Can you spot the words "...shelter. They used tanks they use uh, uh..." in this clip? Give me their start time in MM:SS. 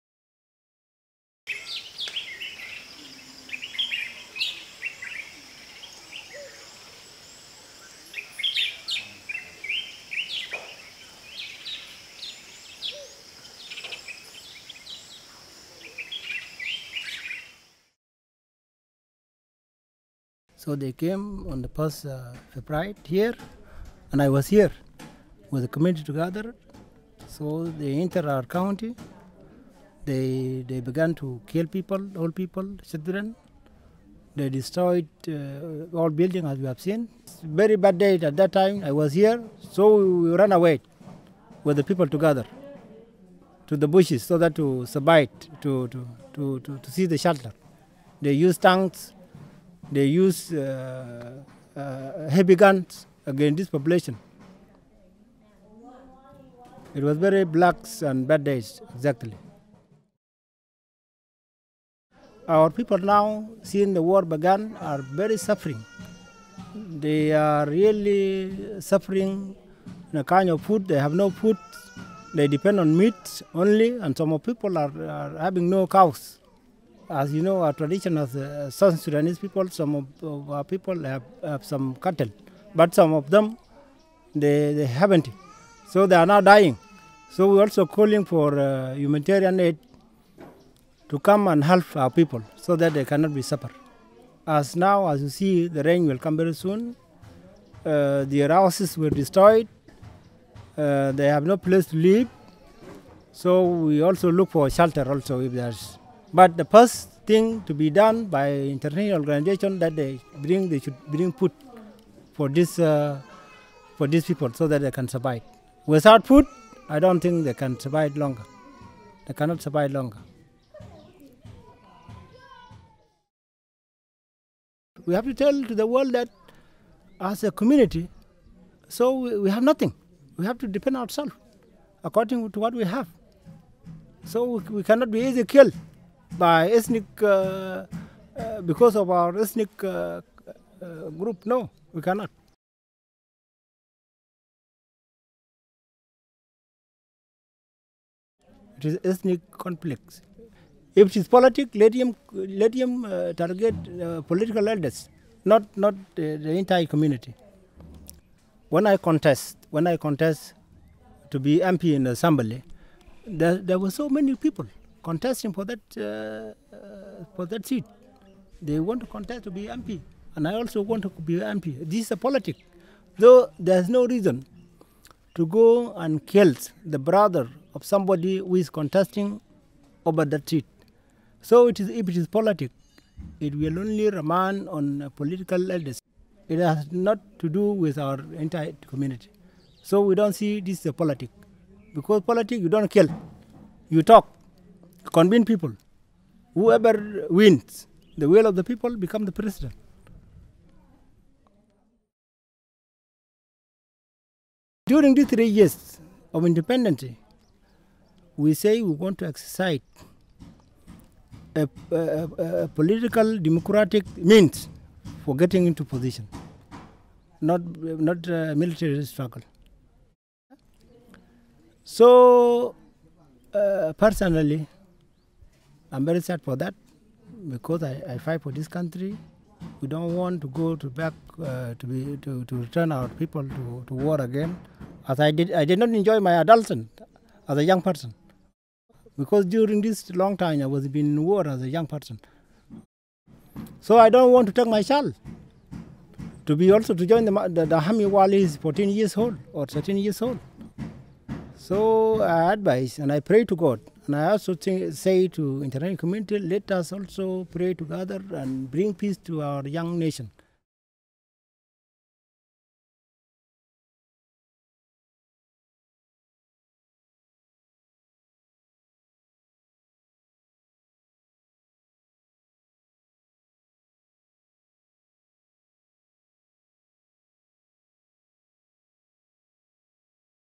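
00:47.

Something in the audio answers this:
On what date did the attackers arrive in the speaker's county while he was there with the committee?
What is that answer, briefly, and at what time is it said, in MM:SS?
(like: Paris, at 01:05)
1 February, at 00:21.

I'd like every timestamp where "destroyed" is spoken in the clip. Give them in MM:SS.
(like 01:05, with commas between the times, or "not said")
00:34, 01:39.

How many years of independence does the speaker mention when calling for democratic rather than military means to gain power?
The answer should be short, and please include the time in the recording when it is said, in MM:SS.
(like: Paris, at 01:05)
3, at 03:25.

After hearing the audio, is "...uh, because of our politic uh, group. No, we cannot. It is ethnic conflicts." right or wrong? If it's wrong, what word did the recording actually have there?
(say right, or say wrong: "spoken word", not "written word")
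wrong: "ethnic", not "politic".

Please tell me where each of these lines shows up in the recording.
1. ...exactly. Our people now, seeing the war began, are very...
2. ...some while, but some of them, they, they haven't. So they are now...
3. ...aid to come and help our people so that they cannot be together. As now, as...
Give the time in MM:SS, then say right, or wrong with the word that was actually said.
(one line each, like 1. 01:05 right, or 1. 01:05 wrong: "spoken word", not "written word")
1. 00:58 right
2. 01:21 wrong: "cattle", not "while"
3. 01:29 wrong: "suffer", not "together".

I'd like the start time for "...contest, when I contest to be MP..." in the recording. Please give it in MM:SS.
02:38.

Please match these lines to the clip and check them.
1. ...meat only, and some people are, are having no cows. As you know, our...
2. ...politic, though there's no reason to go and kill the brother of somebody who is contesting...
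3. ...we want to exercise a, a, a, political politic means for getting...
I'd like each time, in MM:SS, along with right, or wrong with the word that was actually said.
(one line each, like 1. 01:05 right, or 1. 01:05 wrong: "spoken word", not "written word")
1. 01:12 right
2. 02:52 right
3. 03:28 wrong: "democratic", not "politic".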